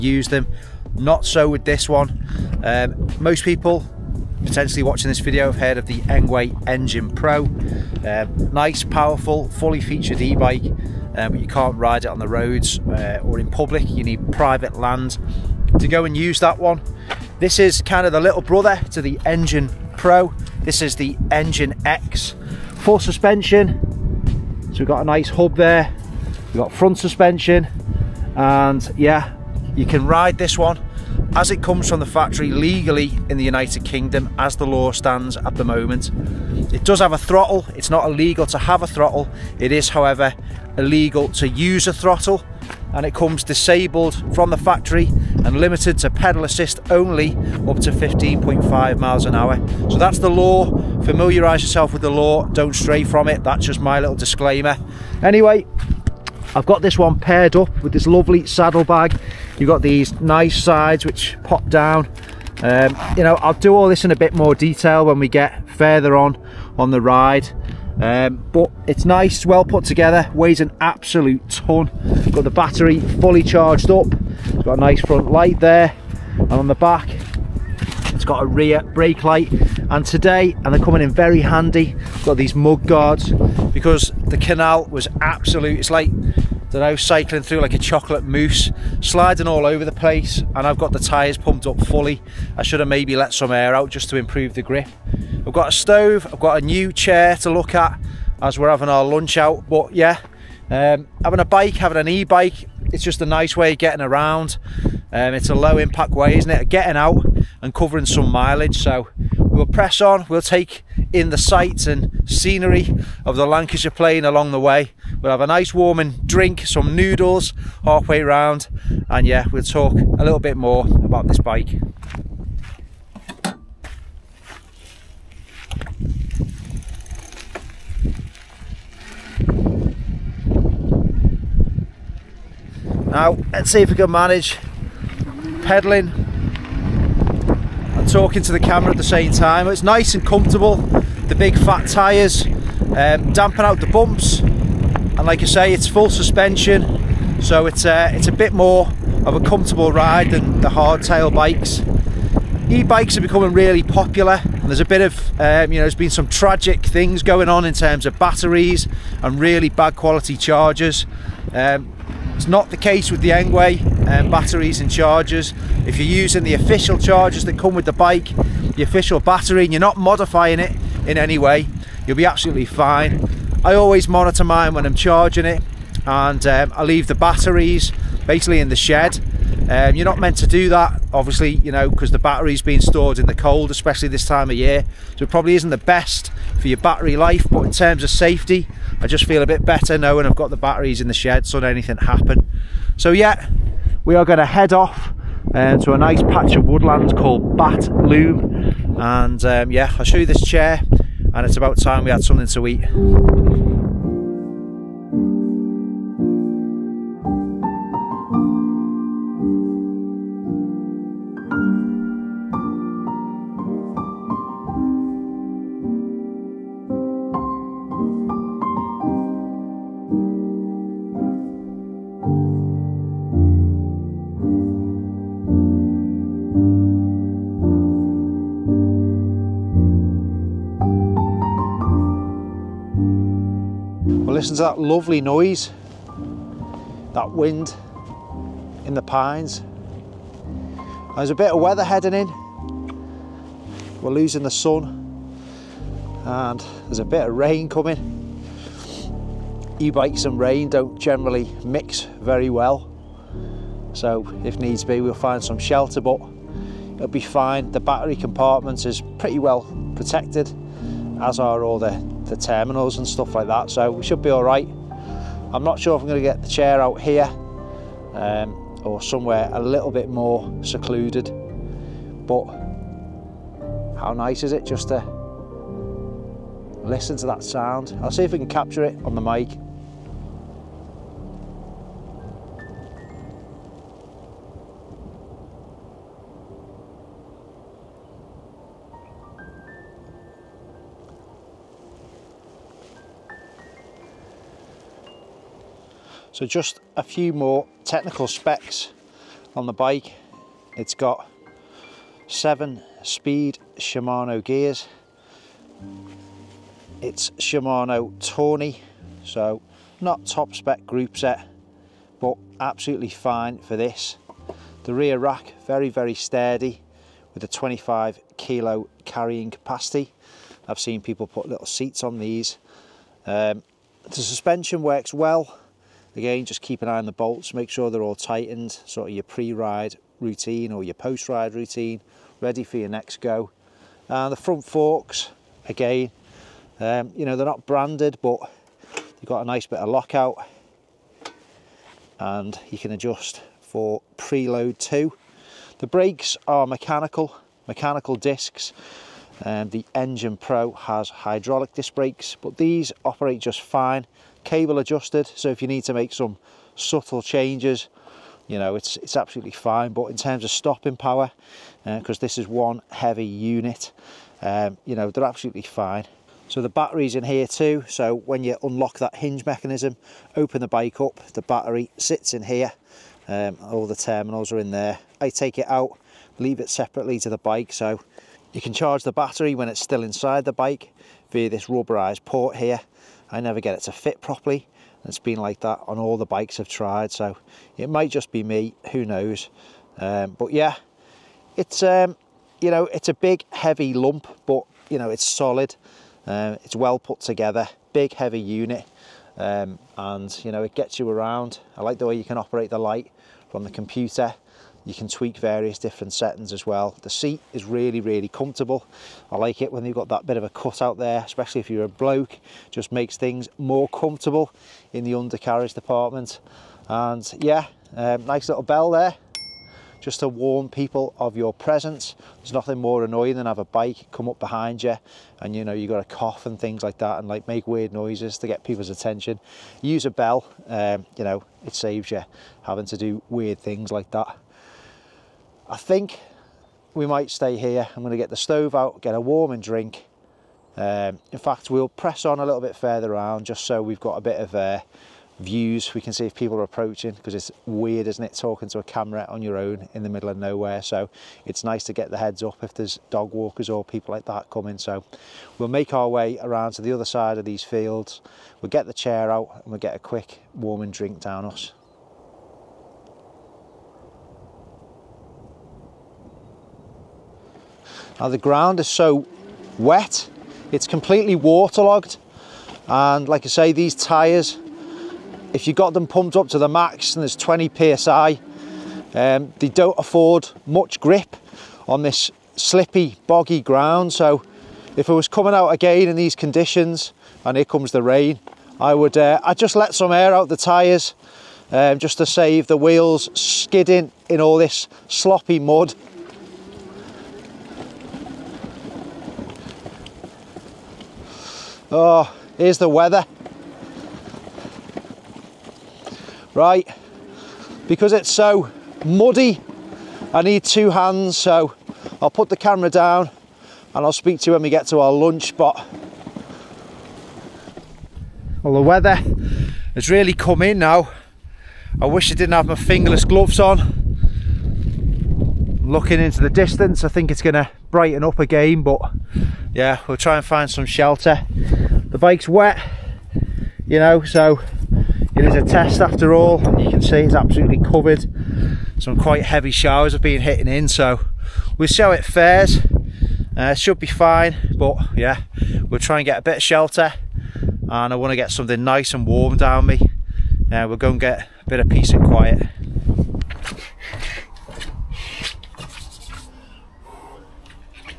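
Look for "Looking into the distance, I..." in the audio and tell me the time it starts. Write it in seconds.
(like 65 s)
525 s.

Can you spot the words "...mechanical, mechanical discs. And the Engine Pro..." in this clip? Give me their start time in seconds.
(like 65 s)
346 s.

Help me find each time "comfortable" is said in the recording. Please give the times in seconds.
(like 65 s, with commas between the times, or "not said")
140 s, 149 s, 408 s, 413 s.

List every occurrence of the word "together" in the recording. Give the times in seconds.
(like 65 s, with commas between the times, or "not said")
69 s, 397 s.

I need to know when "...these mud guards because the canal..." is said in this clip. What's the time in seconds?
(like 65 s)
82 s.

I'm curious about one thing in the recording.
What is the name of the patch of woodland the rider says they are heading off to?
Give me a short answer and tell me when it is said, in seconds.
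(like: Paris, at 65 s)
Bat Loom, at 197 s.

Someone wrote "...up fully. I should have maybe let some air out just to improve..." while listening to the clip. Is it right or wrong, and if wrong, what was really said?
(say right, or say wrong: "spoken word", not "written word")
right.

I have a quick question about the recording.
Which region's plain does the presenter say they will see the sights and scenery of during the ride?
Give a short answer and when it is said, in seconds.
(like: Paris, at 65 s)
Lancashire Plain, at 113 s.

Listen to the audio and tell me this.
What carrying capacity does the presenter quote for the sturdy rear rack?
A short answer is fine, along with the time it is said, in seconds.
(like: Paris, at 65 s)
25 kg, at 317 s.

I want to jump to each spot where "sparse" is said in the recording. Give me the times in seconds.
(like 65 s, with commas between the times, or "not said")
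not said.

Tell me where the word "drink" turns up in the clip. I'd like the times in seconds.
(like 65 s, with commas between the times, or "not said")
116 s, 439 s, 460 s.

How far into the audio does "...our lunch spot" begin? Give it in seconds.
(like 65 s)
514 s.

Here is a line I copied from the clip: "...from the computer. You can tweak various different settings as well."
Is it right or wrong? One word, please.
right.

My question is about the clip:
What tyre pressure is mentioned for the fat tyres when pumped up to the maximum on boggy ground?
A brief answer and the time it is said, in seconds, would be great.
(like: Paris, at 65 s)
20 PSI, at 477 s.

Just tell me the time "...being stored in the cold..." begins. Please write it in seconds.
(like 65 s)
182 s.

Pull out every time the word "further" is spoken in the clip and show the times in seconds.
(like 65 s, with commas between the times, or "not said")
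65 s, 442 s.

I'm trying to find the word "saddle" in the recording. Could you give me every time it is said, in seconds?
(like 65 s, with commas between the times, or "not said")
58 s.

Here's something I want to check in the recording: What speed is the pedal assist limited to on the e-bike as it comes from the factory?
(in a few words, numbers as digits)
15.5 mph.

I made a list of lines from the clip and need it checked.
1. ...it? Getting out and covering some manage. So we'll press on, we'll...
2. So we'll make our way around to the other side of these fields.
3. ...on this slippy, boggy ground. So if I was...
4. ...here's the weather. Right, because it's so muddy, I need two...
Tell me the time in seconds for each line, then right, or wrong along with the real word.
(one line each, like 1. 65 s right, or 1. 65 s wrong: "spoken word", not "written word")
1. 106 s wrong: "mileage", not "manage"
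2. 454 s right
3. 481 s right
4. 502 s right.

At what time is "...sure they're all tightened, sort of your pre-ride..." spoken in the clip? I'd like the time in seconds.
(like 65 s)
327 s.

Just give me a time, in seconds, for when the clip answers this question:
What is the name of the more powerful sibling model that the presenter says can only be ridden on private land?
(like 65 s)
6 s.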